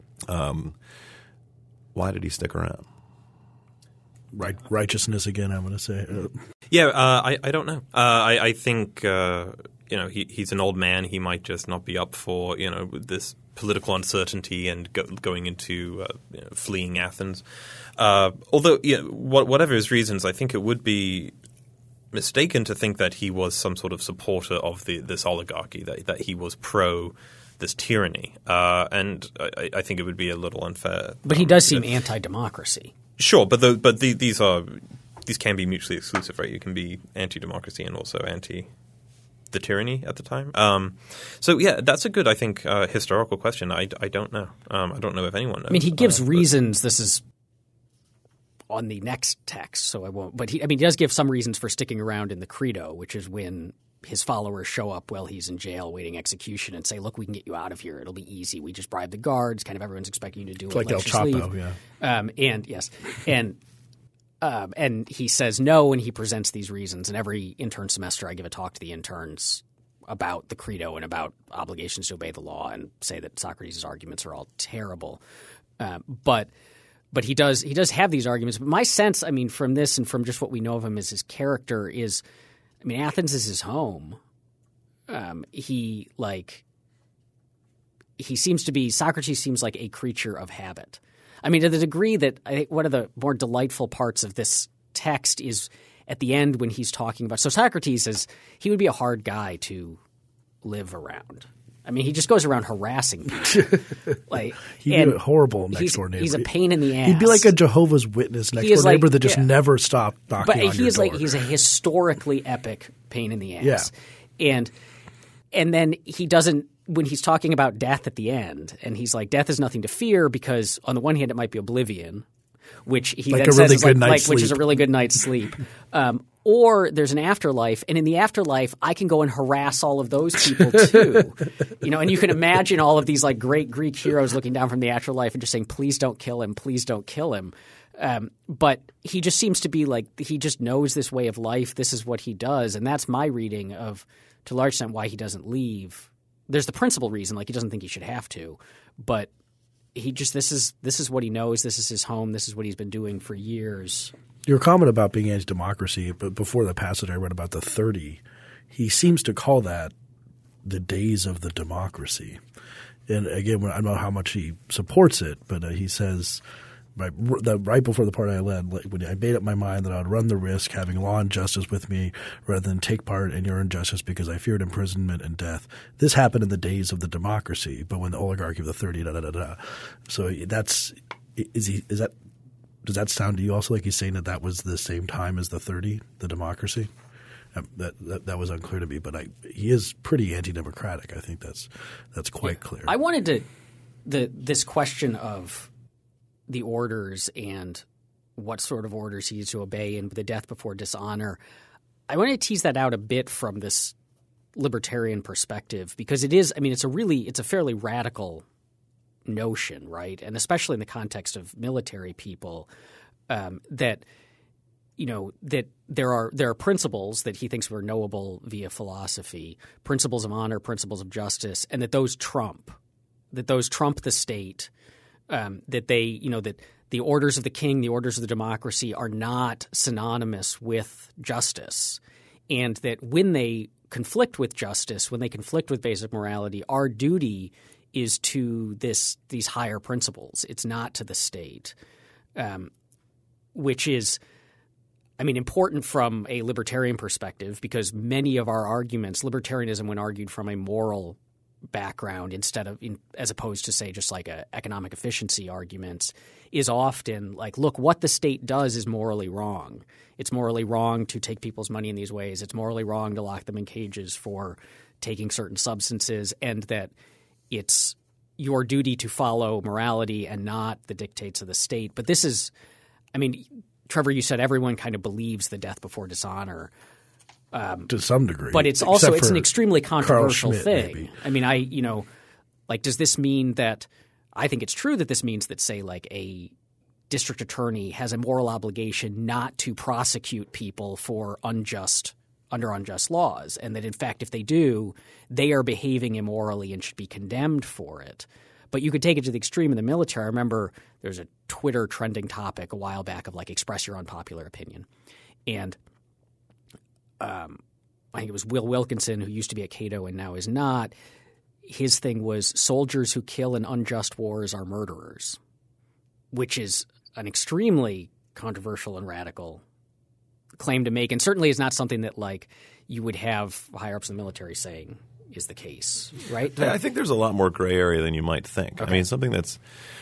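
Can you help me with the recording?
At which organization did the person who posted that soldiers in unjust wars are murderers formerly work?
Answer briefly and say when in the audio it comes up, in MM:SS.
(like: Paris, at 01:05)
Cato, at 05:09.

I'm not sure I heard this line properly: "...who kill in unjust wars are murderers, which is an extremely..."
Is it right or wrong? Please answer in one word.
right.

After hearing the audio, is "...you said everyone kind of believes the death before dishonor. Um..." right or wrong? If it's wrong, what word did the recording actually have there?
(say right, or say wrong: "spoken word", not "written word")
right.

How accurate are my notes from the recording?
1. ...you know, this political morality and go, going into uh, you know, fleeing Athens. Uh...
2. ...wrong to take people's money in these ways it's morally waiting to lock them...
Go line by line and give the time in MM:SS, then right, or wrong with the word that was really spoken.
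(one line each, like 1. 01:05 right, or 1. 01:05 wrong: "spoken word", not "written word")
1. 00:12 wrong: "uncertainty", not "morality"
2. 04:20 wrong: "wrong", not "waiting".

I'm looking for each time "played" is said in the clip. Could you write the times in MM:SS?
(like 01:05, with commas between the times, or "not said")
not said.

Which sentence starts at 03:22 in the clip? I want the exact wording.
I want to tease that out a bit from this libertarian perspective because it is.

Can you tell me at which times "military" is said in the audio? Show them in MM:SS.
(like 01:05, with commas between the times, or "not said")
03:31, 04:59, 05:24.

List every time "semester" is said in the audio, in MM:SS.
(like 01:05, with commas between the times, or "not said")
01:07.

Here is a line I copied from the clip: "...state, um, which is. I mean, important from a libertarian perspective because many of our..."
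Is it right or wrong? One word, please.
right.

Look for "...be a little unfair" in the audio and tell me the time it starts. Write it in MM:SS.
00:30.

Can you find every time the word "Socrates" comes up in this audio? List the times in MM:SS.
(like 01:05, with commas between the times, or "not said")
01:13, 01:28, 01:37.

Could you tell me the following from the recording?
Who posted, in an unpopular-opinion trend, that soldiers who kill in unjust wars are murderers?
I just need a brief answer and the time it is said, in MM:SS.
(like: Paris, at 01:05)
Will Wilkinson, at 05:08.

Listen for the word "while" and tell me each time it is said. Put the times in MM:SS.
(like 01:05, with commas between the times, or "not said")
00:55, 05:02.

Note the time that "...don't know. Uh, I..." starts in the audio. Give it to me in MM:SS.
00:07.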